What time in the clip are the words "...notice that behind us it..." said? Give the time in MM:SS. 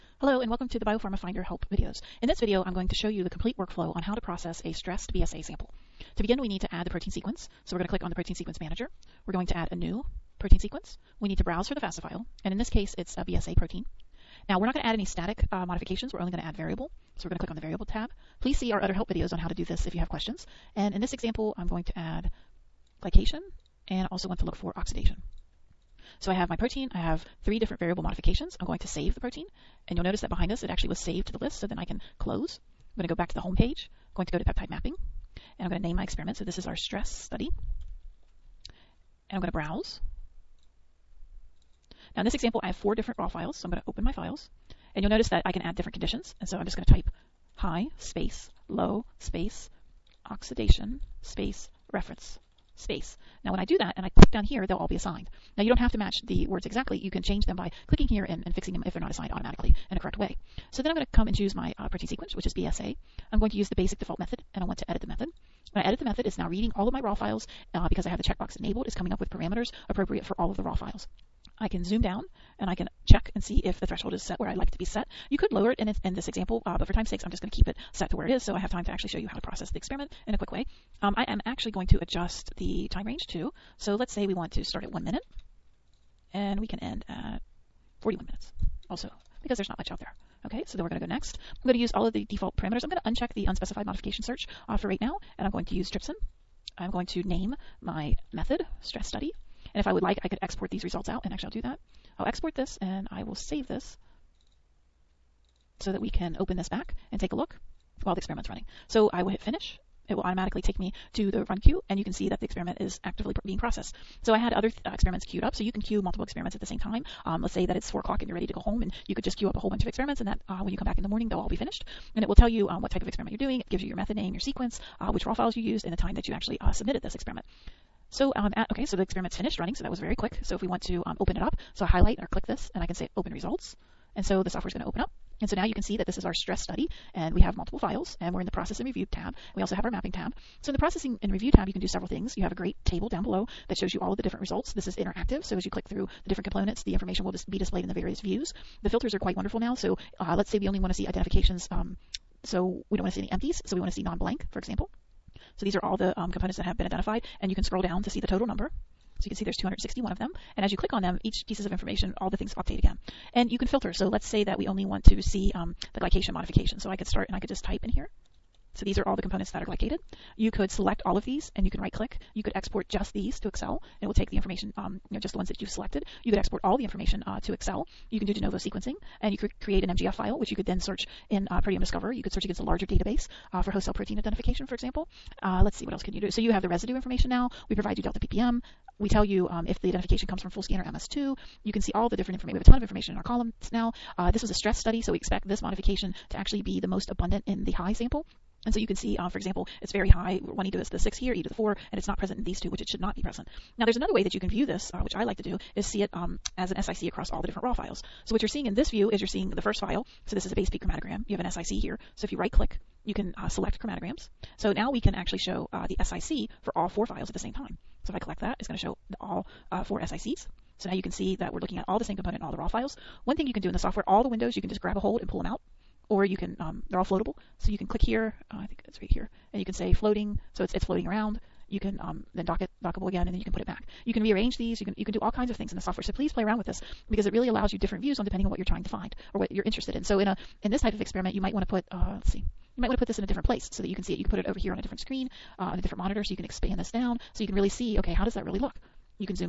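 00:30.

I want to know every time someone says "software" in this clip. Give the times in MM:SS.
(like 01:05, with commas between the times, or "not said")
02:14, 03:43, 03:55.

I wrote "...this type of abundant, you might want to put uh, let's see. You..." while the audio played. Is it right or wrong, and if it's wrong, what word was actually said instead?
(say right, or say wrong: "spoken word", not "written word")
wrong: "experiment", not "abundant".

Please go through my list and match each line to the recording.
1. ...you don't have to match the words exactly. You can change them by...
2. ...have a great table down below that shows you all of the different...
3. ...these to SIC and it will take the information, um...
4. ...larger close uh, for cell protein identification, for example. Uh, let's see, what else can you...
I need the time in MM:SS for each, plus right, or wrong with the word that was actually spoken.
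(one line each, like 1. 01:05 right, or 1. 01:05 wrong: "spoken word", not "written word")
1. 00:55 right
2. 02:22 right
3. 02:53 wrong: "Excel", not "SIC"
4. 03:02 wrong: "database", not "close".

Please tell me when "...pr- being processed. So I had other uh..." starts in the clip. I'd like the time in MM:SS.
01:53.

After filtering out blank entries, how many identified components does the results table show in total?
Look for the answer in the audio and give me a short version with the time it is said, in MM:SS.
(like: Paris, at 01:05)
261, at 02:39.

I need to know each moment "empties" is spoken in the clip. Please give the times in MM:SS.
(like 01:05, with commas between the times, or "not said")
02:33.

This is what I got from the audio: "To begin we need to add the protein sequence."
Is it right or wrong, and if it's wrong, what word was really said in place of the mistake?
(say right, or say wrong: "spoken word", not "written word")
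right.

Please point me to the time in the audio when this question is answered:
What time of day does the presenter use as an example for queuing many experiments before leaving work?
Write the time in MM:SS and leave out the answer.
01:57.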